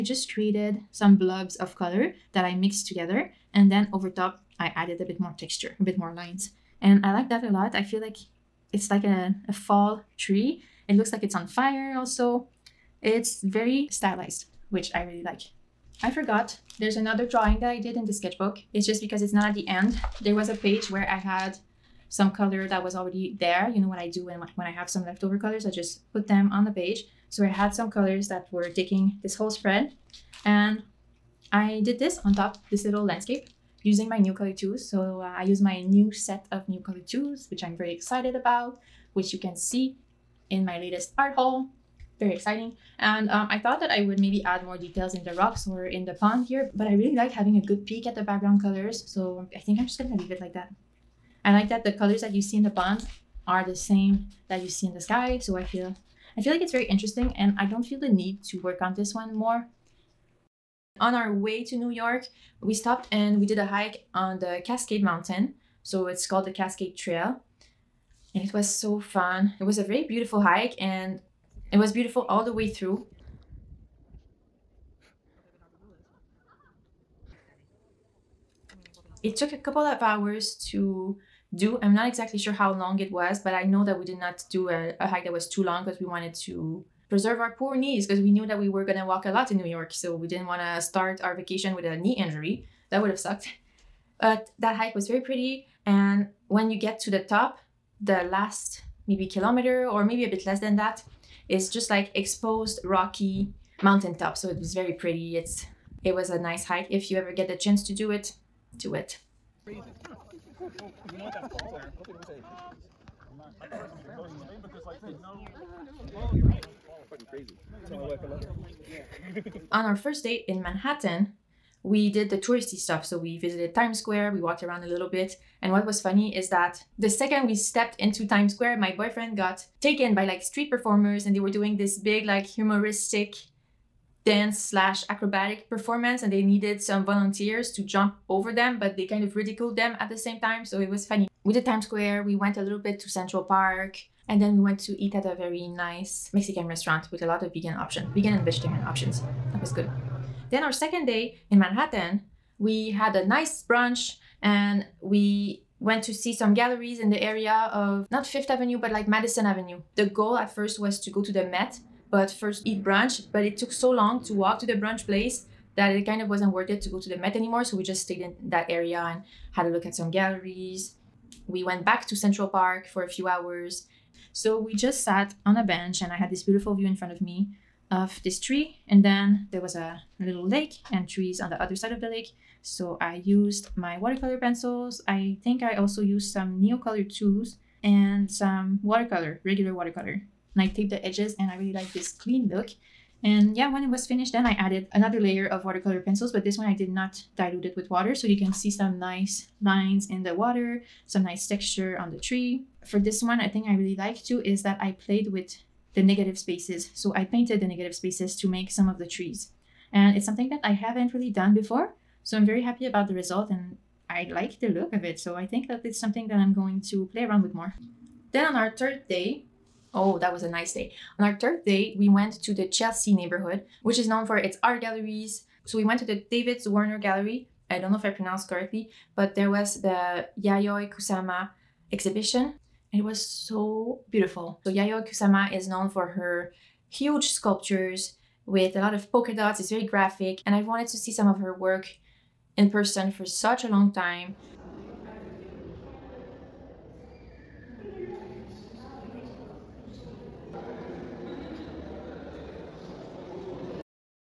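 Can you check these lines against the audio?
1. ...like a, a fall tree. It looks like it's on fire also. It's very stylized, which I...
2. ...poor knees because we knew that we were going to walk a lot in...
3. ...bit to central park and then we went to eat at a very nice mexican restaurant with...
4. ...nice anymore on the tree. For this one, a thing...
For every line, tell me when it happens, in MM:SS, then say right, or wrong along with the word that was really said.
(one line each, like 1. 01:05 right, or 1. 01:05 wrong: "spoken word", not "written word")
1. 00:08 right
2. 01:27 right
3. 02:22 right
4. 03:21 wrong: "texture", not "anymore".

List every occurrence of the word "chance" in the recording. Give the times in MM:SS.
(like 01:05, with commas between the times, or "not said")
01:47.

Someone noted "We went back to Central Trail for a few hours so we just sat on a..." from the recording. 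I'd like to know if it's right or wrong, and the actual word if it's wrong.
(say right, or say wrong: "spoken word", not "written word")
wrong: "Park", not "Trail".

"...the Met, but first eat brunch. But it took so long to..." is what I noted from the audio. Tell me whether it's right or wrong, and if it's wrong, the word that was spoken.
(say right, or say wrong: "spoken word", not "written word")
right.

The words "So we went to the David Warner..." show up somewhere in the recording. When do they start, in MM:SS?
03:45.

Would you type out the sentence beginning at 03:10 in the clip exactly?
And I taped the edges and I really like this clean look.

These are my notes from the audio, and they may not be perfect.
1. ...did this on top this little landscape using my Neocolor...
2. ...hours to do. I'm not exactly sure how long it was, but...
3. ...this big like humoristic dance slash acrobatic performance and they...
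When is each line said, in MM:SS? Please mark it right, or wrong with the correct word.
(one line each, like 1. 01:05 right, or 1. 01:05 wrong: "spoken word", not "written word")
1. 00:31 right
2. 01:20 right
3. 02:11 right.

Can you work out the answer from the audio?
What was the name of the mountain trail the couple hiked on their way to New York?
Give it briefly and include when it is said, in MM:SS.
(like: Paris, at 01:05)
Cascade Trail, at 01:06.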